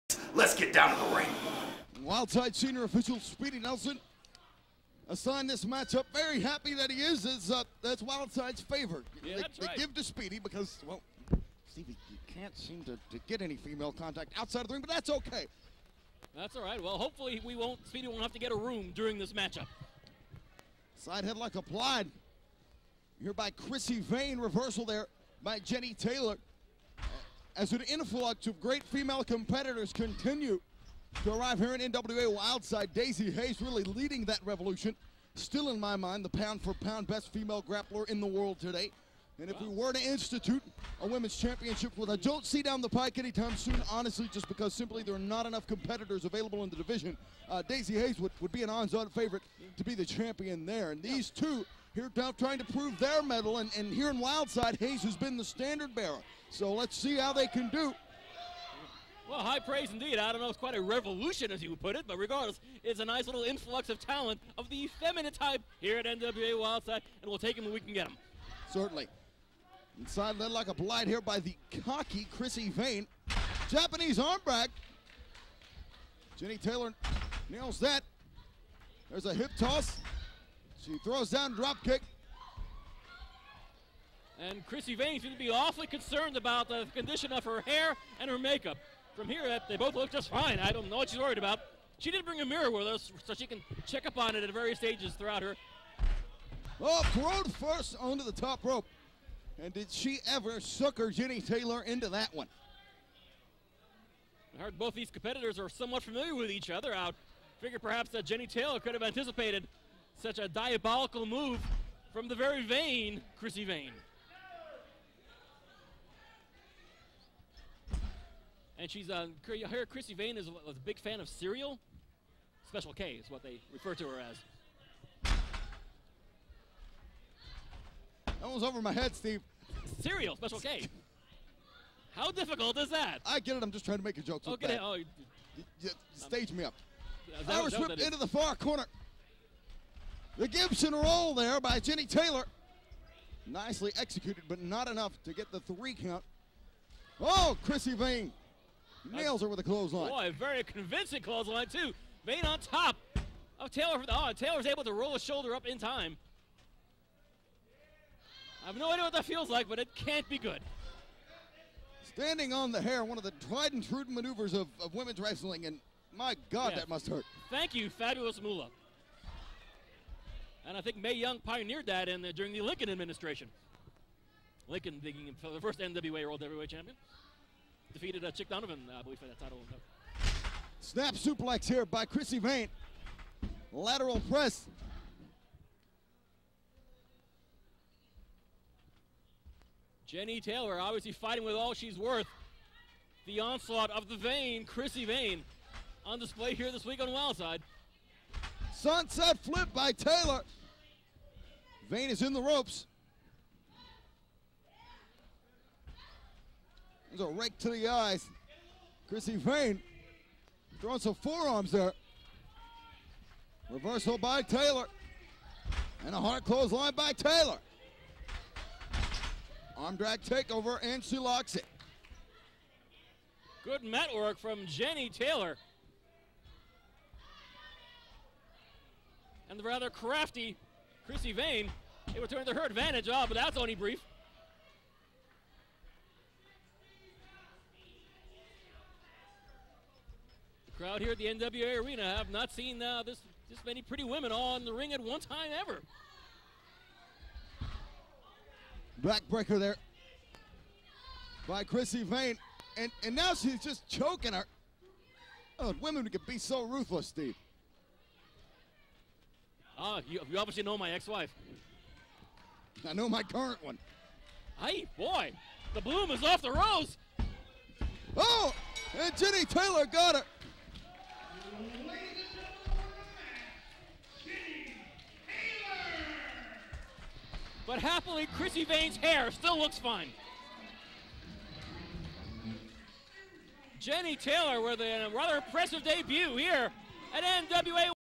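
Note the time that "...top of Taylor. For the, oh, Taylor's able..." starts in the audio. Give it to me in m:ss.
2:32.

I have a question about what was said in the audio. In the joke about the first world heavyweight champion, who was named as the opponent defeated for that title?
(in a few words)
Chick Donovan.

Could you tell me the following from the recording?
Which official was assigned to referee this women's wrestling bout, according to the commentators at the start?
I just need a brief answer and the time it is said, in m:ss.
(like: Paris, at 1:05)
Speedy Nelson, at 0:03.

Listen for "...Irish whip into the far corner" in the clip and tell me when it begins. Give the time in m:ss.
2:17.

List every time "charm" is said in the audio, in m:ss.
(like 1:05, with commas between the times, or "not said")
not said.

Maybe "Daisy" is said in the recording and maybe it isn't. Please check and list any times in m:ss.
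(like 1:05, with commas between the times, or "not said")
0:32, 0:47.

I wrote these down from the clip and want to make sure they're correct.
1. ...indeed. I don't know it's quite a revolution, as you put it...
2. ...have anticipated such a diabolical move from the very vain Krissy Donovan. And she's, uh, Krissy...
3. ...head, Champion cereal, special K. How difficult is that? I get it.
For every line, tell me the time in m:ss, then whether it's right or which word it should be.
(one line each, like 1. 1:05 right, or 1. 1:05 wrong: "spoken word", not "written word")
1. 0:59 right
2. 1:48 wrong: "Vaine", not "Donovan"
3. 2:08 wrong: "Steve", not "Champion".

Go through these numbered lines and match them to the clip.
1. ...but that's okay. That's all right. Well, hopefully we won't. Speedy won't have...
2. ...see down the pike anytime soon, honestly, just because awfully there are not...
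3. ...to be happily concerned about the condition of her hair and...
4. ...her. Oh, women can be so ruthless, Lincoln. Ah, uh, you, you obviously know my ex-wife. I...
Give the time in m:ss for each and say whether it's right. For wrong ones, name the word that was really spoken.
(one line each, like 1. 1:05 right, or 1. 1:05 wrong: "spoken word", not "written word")
1. 0:14 right
2. 0:42 wrong: "simply", not "awfully"
3. 1:25 wrong: "awfully", not "happily"
4. 4:14 wrong: "Steve", not "Lincoln".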